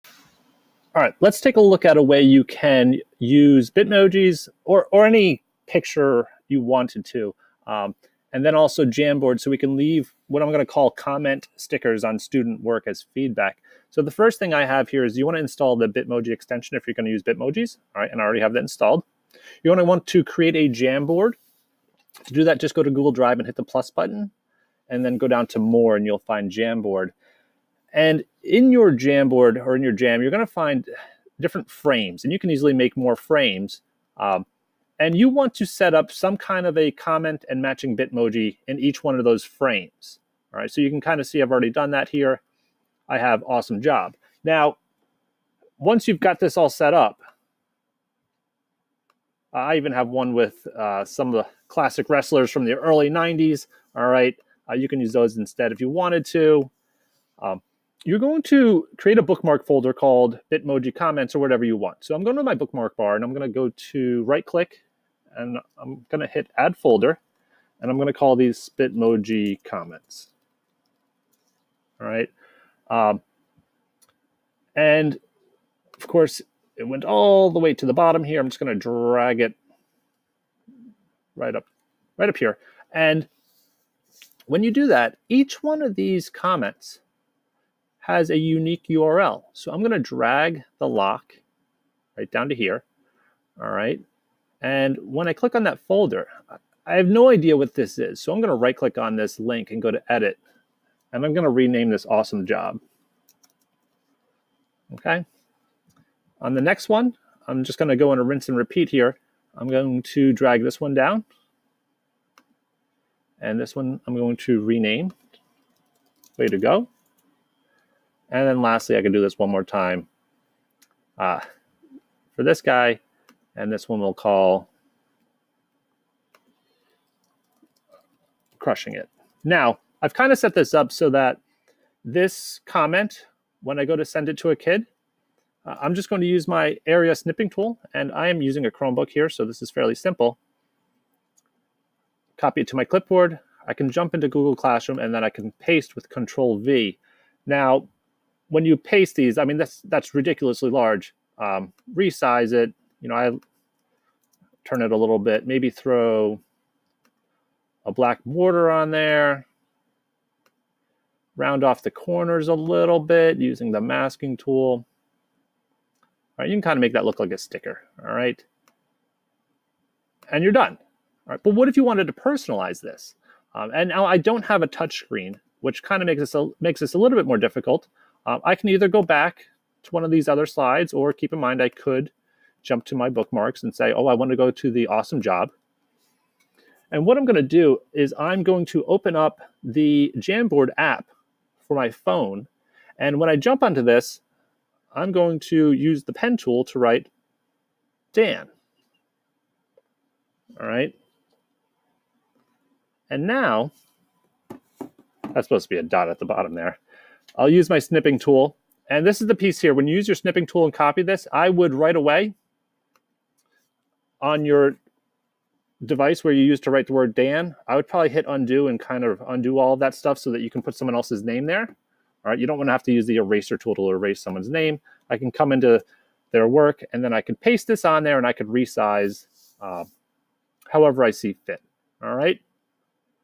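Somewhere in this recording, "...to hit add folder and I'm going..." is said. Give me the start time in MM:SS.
01:06.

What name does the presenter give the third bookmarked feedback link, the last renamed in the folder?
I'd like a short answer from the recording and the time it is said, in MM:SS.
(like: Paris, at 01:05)
Crushing it, at 02:08.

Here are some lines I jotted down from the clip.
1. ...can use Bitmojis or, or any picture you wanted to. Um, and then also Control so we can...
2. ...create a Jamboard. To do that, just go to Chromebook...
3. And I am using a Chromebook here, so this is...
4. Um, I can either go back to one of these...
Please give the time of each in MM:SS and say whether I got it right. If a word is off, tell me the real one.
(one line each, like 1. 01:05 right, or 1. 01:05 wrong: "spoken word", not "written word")
1. 00:02 wrong: "Jamboard", not "Control"
2. 00:20 wrong: "Google", not "Chromebook"
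3. 02:17 right
4. 02:58 right.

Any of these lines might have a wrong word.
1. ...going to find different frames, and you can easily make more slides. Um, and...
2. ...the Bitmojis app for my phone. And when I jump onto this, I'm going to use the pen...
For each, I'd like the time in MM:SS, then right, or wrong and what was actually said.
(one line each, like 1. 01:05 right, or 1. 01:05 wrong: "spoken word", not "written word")
1. 00:30 wrong: "frames", not "slides"
2. 03:09 wrong: "Jamboard", not "Bitmojis".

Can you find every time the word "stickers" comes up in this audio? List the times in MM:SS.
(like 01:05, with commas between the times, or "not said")
00:11, 02:47.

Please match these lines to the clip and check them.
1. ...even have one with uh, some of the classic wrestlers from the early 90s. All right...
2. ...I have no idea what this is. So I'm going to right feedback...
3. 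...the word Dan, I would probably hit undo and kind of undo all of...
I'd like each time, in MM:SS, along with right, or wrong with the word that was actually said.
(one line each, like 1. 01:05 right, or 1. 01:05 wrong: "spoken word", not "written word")
1. 00:49 right
2. 01:36 wrong: "click", not "feedback"
3. 03:36 right.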